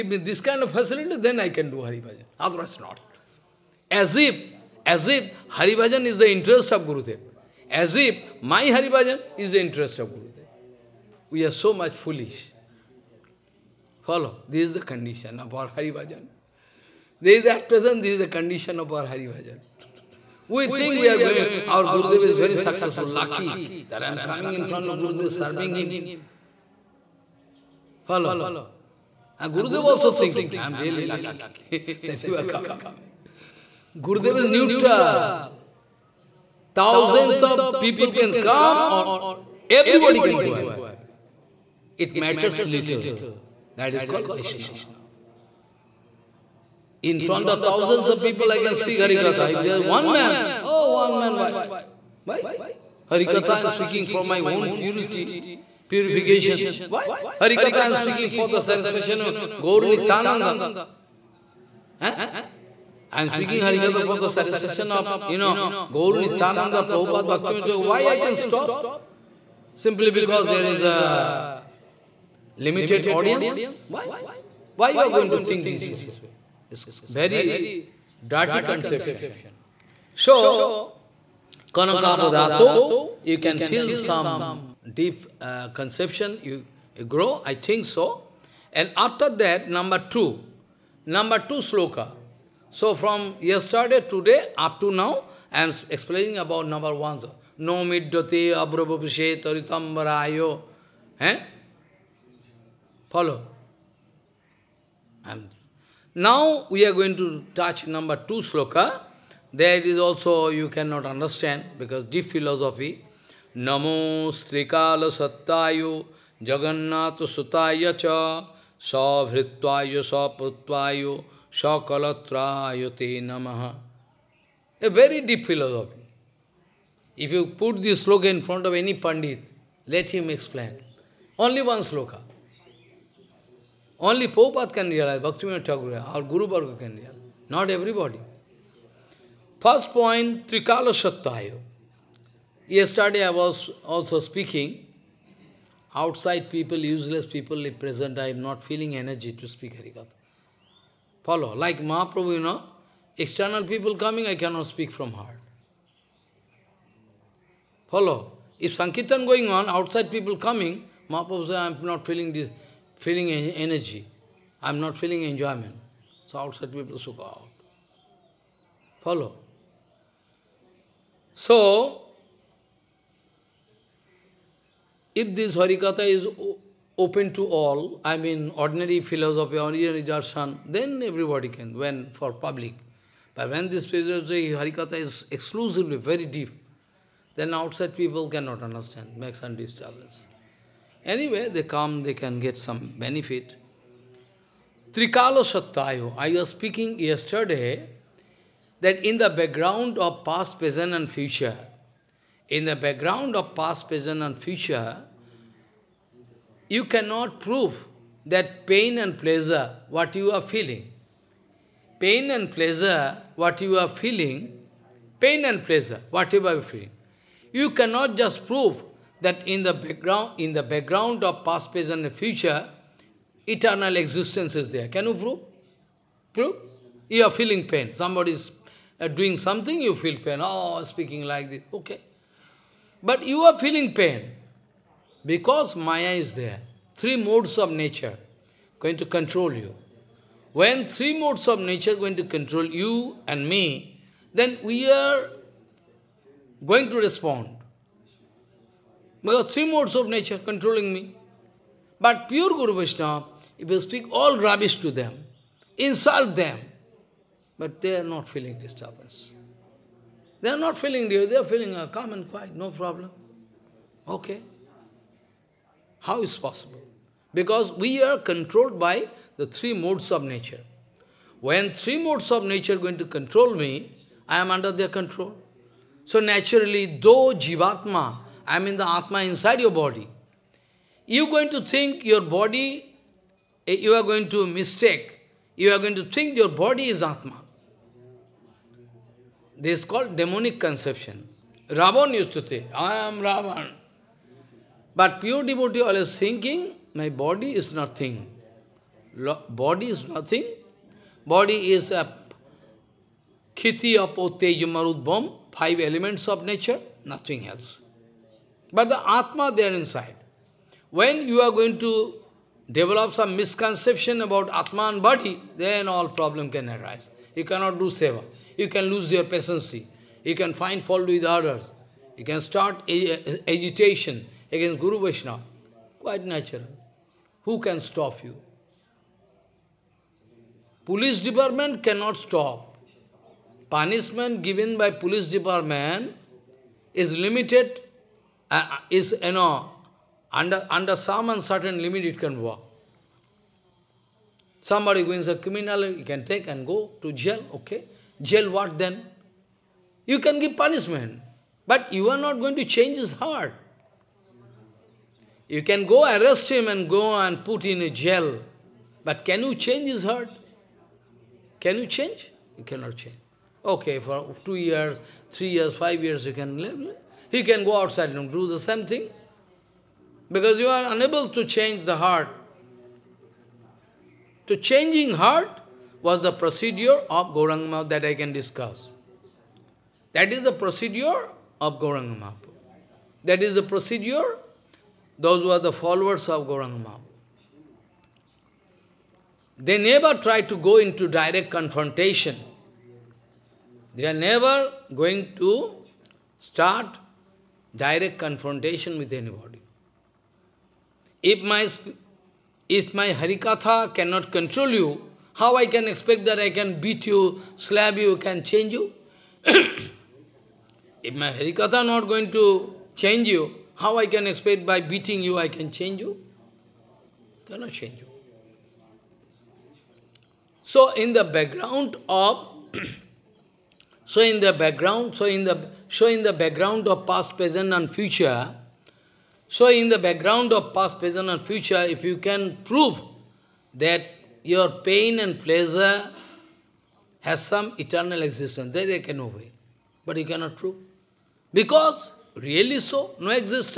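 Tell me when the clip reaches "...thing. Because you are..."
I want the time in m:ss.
6:08.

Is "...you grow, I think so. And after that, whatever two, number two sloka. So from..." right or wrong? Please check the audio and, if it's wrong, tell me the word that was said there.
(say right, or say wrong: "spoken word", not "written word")
wrong: "number", not "whatever".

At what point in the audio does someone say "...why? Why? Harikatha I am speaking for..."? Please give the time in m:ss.
0:51.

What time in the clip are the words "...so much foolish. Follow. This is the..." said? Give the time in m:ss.
0:11.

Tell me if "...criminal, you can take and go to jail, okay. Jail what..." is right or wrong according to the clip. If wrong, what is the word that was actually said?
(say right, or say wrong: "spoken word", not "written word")
right.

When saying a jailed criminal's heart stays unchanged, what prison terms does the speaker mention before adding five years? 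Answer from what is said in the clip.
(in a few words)
2 years, 3 years.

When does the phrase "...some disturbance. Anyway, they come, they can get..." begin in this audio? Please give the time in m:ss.
3:09.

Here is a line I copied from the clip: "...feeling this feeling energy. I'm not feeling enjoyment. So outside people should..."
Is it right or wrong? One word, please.
right.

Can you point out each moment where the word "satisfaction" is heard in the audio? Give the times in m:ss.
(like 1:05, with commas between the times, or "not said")
0:58, 1:04.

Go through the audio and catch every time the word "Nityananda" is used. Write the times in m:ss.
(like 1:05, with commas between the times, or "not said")
0:59, 1:06.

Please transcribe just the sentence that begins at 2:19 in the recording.
First point, Trikala Yesterday I was also speaking, outside people, useless people, if present, I am not feeling energy to speak Harikatha.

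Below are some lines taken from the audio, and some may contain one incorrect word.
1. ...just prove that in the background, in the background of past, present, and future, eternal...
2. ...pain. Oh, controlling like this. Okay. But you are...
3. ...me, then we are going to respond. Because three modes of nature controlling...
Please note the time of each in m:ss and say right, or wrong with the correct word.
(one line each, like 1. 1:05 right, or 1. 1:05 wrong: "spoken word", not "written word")
1. 3:38 right
2. 3:50 wrong: "speaking", not "controlling"
3. 4:03 right.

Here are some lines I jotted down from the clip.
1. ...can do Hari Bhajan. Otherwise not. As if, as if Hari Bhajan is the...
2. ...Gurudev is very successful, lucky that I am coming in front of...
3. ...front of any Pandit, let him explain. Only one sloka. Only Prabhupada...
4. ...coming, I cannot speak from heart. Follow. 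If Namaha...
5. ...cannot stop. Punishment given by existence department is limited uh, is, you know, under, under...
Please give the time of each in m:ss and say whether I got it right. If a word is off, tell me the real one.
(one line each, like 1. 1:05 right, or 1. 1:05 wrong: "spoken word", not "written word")
1. 0:01 right
2. 0:21 right
3. 2:08 right
4. 2:33 wrong: "Sankirtan", not "Namaha"
5. 5:31 wrong: "police", not "existence".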